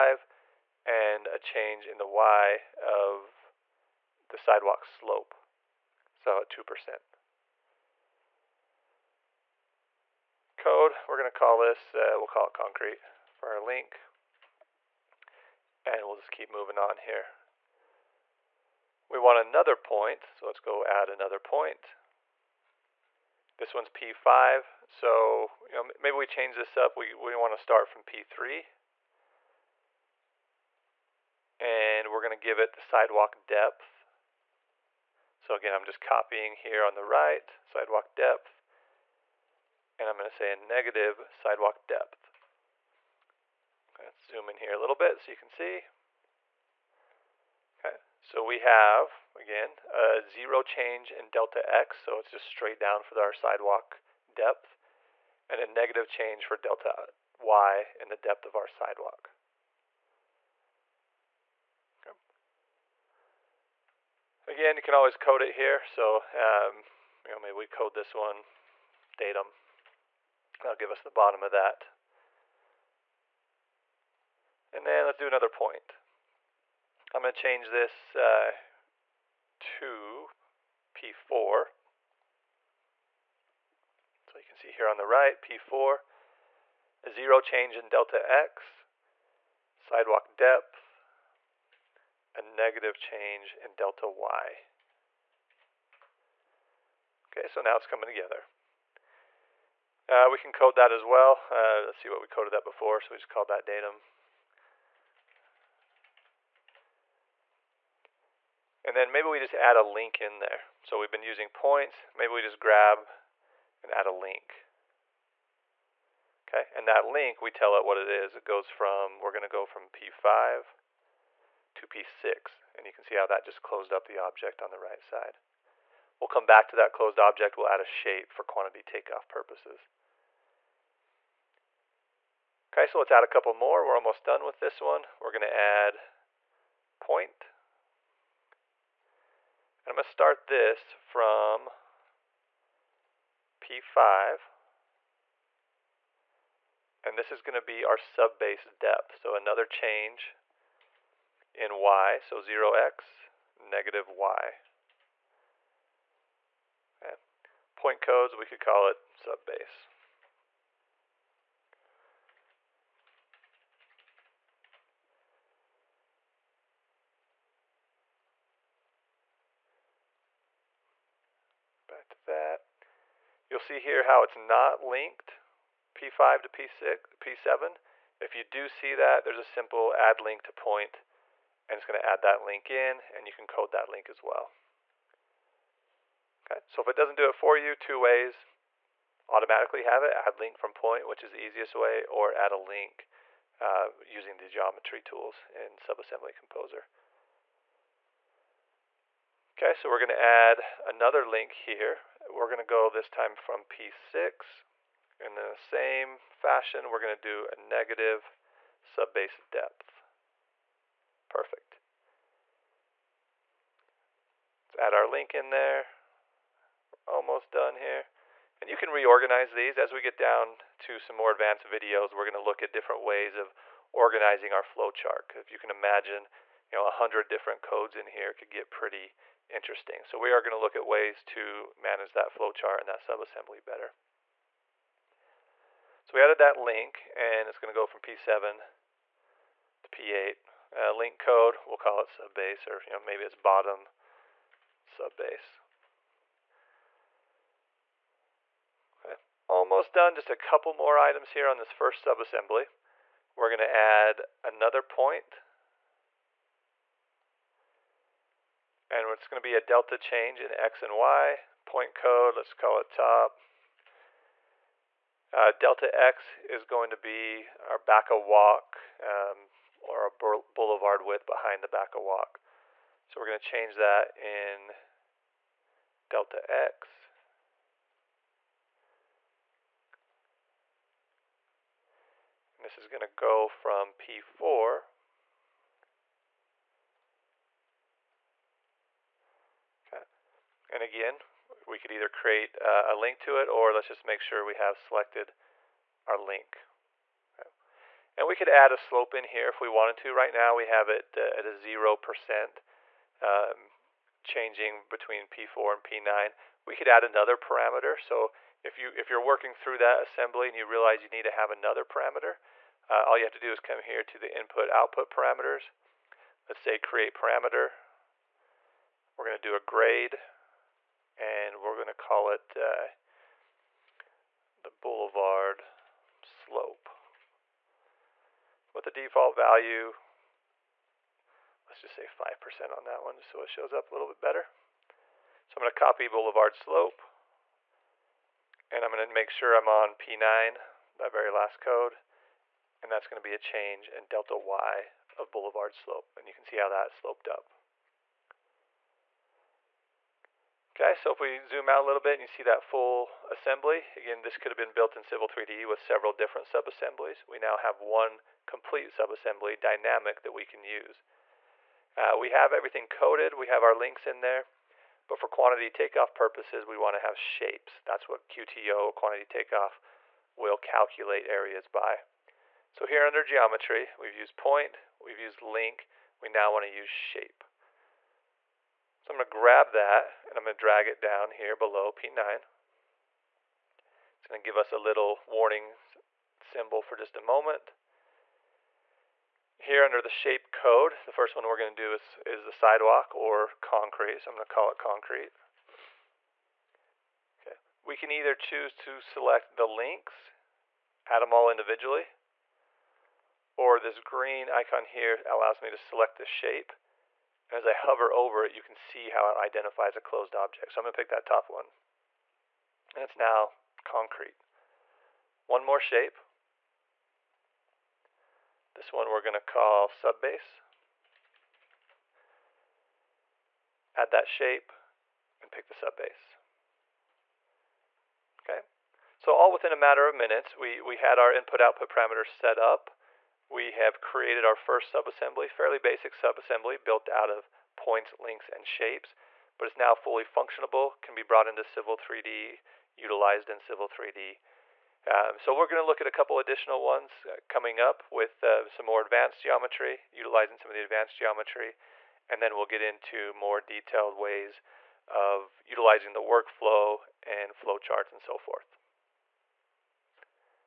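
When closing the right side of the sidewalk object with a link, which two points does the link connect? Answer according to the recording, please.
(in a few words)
P5 to P6.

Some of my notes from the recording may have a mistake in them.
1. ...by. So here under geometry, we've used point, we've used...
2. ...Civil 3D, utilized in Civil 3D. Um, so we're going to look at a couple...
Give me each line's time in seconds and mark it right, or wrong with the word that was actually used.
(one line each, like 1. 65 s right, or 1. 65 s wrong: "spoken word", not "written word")
1. 371 s right
2. 441 s right.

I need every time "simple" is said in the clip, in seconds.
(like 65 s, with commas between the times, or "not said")
179 s.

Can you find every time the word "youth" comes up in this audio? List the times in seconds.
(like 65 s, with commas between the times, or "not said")
not said.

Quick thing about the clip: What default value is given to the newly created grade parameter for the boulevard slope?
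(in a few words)
5%.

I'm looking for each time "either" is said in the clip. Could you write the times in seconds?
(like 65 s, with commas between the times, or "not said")
291 s, 398 s.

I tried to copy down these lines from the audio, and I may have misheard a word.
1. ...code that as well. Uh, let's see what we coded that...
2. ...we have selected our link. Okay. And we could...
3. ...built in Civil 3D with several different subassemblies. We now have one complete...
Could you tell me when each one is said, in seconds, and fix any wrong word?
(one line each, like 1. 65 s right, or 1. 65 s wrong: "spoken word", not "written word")
1. 100 s right
2. 294 s right
3. 354 s right.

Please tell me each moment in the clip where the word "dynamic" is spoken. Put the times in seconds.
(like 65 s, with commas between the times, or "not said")
359 s.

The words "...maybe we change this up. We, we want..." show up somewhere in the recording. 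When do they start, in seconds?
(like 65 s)
25 s.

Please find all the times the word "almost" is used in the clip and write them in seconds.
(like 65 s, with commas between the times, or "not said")
133 s, 217 s, 249 s.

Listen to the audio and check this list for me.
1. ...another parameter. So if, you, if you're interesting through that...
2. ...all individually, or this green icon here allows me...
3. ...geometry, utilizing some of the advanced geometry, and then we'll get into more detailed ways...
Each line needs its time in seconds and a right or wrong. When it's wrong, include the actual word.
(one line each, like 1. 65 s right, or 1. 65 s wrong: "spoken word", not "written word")
1. 307 s wrong: "working", not "interesting"
2. 401 s right
3. 449 s right.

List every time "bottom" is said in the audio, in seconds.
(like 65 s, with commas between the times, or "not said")
71 s, 243 s.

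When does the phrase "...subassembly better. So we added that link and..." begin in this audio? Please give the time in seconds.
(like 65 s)
232 s.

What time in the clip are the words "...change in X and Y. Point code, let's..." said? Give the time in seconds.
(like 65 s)
259 s.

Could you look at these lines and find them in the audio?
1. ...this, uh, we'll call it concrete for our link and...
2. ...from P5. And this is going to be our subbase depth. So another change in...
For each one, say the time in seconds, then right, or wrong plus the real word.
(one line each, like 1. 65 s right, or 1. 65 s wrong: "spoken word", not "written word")
1. 11 s right
2. 141 s right.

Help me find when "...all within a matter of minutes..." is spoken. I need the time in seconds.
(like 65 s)
429 s.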